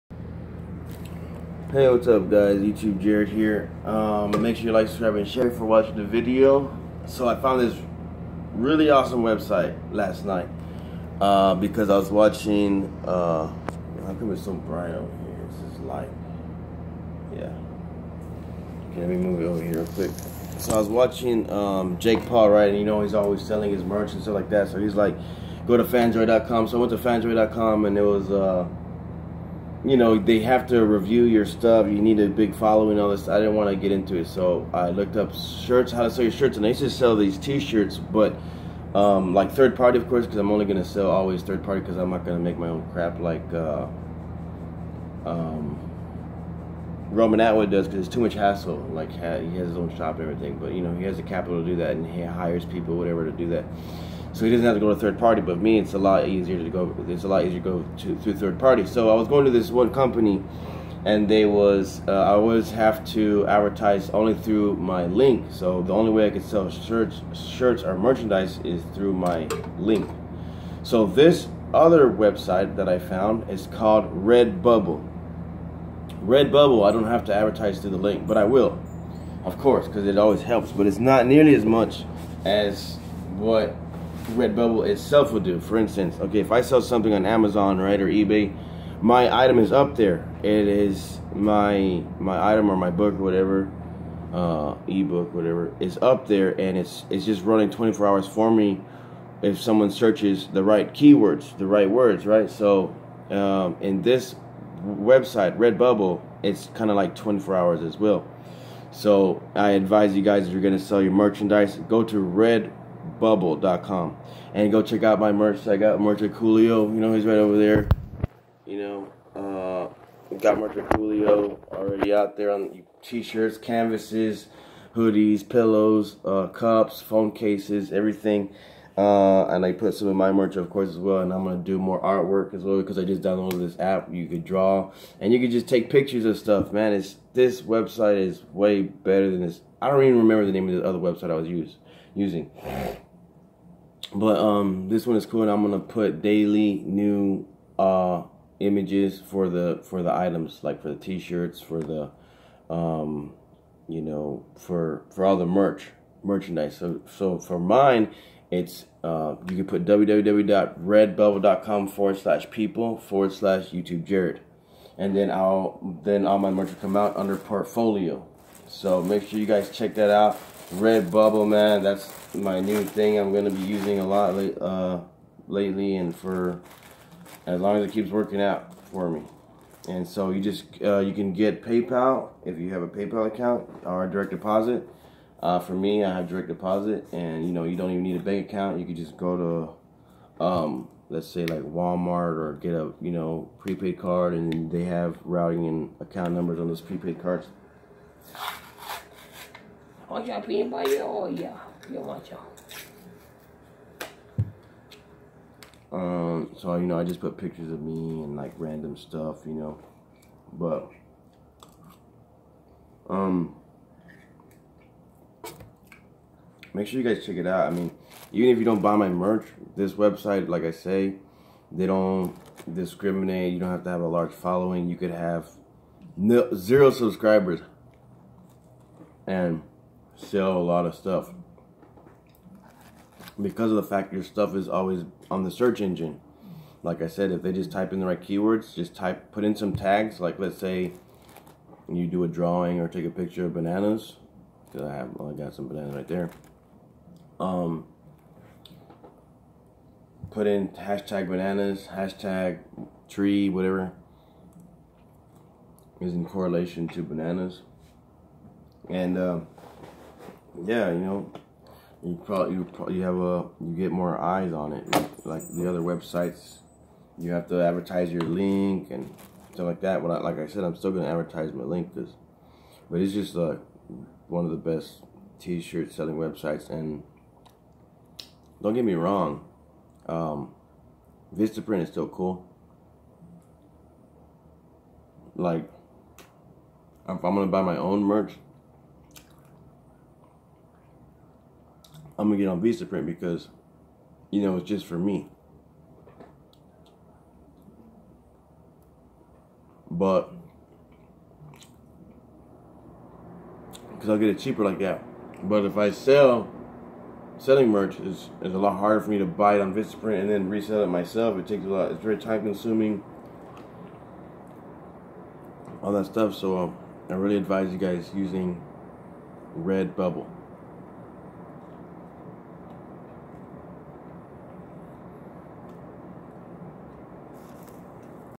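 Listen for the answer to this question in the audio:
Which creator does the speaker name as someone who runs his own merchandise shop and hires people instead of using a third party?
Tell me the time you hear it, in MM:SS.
00:47.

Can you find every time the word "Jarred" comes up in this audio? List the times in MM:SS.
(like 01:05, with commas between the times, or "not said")
00:02, 02:44.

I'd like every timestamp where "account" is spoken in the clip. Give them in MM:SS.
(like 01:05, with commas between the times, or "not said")
03:03, 03:08, 03:15.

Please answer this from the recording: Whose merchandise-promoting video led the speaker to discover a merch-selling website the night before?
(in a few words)
Jake Paul.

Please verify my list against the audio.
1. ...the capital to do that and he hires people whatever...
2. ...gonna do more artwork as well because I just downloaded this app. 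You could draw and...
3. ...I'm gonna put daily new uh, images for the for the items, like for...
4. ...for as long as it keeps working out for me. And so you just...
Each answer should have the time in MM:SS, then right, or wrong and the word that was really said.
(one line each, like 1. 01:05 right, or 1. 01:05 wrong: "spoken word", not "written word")
1. 00:51 right
2. 02:11 right
3. 02:25 right
4. 02:56 right.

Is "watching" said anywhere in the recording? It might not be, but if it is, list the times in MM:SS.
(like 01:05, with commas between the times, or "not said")
00:05, 00:12, 00:20.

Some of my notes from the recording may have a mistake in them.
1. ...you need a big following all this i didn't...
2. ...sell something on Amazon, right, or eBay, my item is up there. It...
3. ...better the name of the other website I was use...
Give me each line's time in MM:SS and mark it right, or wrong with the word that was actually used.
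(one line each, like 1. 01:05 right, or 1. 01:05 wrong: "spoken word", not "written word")
1. 00:31 right
2. 01:26 right
3. 02:20 wrong: "remember", not "better".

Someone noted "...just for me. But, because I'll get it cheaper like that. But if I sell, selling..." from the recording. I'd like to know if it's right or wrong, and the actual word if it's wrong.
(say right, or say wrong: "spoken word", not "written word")
right.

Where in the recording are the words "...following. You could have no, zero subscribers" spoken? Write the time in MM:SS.
03:44.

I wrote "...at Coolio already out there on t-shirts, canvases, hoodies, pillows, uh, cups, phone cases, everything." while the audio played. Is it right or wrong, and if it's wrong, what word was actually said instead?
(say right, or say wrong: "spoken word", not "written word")
right.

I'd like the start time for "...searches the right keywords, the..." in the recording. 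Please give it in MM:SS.
01:39.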